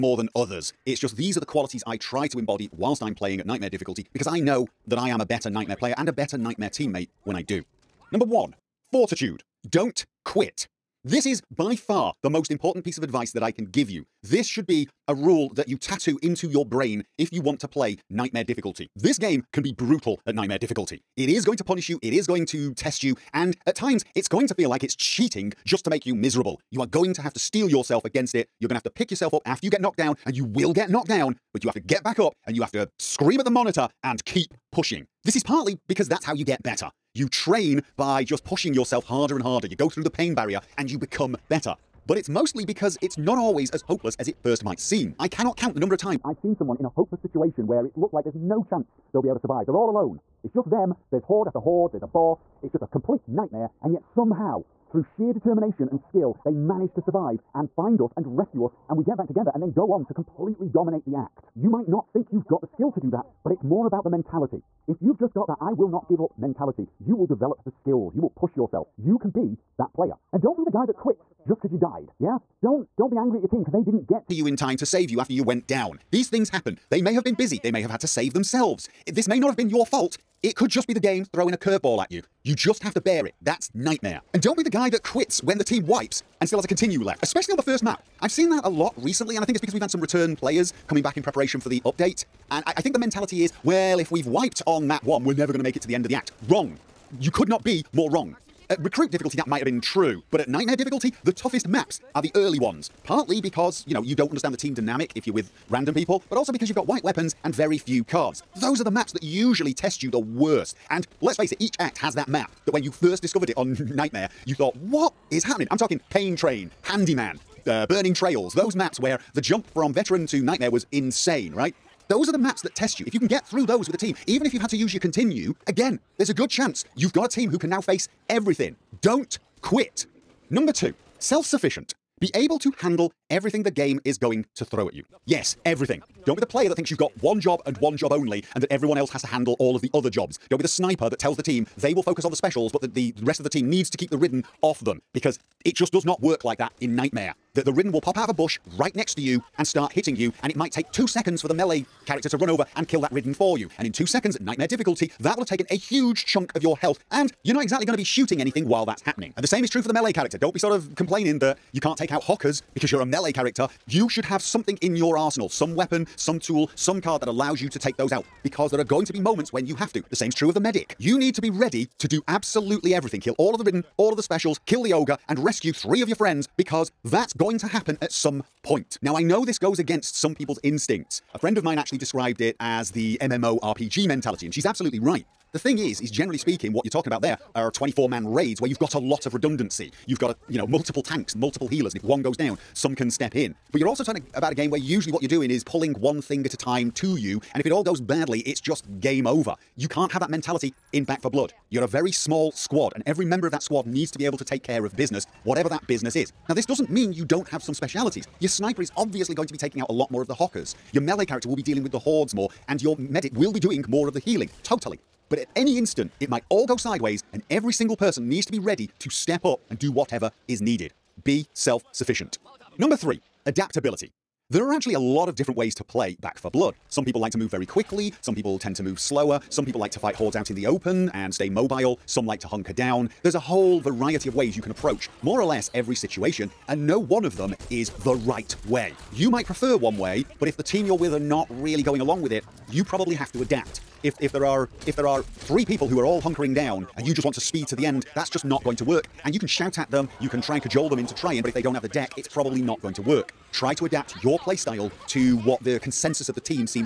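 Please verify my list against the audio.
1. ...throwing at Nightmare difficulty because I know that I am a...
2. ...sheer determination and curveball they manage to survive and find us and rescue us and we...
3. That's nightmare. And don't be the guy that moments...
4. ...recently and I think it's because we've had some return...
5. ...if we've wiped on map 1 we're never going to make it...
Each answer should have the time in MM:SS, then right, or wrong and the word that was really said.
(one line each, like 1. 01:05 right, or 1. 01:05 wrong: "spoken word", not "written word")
1. 00:03 wrong: "playing", not "throwing"
2. 00:55 wrong: "skill", not "curveball"
3. 01:23 wrong: "quits", not "moments"
4. 01:28 right
5. 01:33 right.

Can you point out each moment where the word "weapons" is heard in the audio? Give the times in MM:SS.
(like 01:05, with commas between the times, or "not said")
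01:47, 02:45.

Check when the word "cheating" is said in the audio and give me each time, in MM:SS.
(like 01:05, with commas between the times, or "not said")
00:24.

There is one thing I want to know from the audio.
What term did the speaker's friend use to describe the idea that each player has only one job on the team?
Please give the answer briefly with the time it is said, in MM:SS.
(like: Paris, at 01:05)
MMORPG mentality, at 03:03.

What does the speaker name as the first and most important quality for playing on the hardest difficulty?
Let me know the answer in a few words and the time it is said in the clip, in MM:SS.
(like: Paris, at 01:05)
Fortitude, at 00:08.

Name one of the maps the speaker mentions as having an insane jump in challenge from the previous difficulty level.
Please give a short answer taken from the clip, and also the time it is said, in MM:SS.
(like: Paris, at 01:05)
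Pain Train, at 01:56.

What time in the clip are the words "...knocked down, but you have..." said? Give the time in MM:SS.
00:30.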